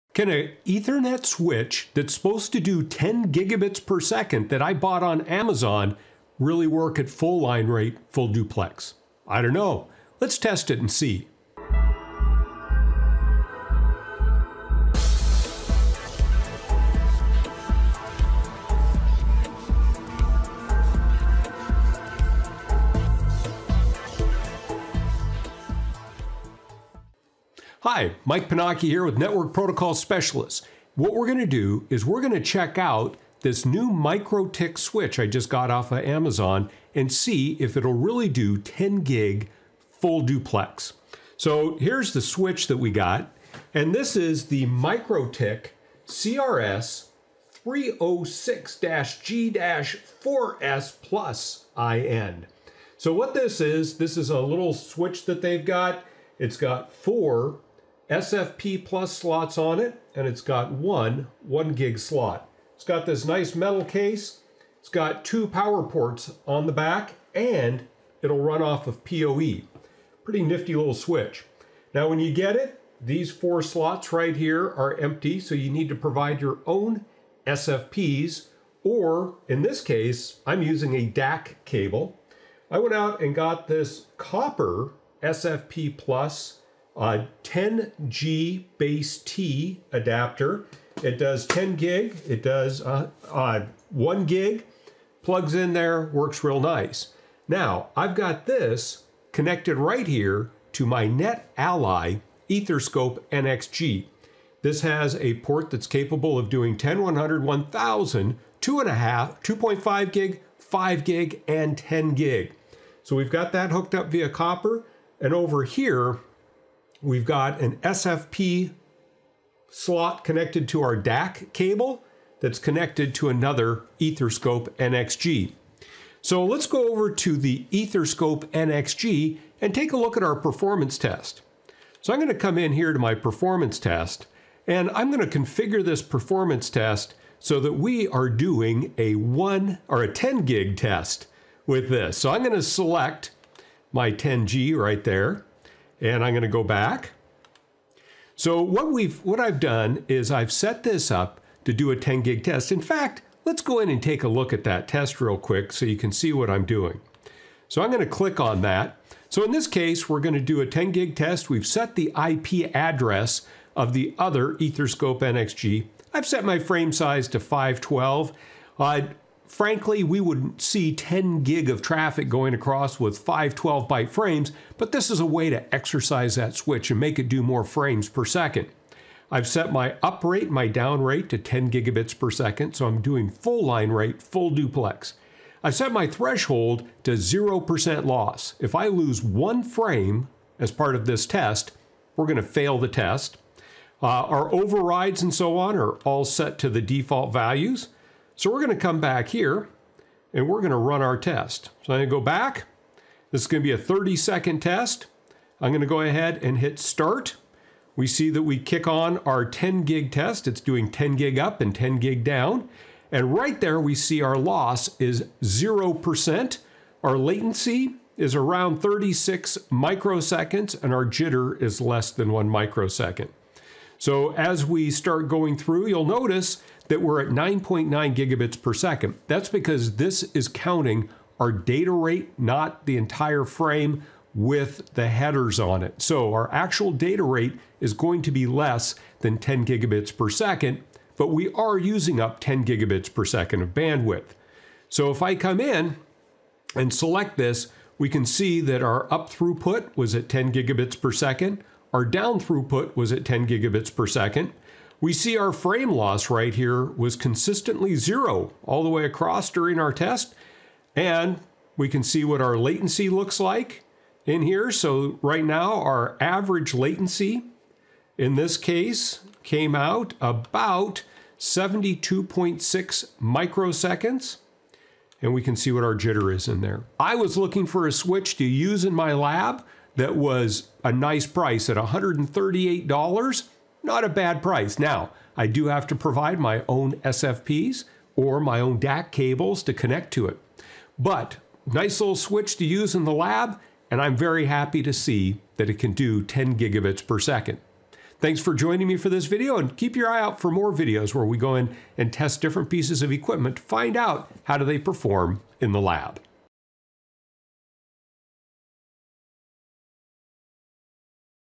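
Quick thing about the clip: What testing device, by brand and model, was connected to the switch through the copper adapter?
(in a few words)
NetAlly EtherScope NXG.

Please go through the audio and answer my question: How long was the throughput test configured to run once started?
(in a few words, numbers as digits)
30 seconds.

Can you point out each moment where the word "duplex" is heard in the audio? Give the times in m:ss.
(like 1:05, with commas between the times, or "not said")
0:08, 0:40, 3:04.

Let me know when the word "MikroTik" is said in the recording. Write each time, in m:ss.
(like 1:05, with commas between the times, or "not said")
0:33, 0:44.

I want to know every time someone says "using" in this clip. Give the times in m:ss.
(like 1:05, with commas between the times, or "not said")
1:20, 4:01.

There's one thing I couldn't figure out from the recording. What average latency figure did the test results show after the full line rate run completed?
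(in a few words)
72.6 microseconds.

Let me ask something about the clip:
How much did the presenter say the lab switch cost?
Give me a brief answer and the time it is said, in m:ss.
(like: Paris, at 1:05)
$138, at 4:41.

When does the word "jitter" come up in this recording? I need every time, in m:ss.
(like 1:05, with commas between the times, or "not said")
3:41, 4:35.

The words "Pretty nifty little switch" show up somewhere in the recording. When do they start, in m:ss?
1:10.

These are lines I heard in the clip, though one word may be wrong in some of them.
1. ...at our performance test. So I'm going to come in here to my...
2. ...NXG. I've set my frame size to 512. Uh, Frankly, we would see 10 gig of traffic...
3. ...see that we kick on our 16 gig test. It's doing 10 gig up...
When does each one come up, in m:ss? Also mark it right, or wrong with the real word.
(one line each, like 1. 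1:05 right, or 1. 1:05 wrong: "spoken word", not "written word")
1. 2:10 right
2. 2:45 right
3. 3:28 wrong: "10", not "16".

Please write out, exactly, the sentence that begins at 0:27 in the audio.
Hi, Mike Pennacchi here with Network Protocol Specialists.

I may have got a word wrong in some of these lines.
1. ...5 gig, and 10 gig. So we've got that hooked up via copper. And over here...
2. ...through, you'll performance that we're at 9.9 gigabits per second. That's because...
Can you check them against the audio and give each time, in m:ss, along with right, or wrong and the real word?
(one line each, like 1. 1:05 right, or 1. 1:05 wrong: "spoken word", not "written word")
1. 1:50 right
2. 3:45 wrong: "notice", not "performance".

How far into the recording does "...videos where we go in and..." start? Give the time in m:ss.
5:00.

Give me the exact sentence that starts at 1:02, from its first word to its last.
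It's got this nice metal case.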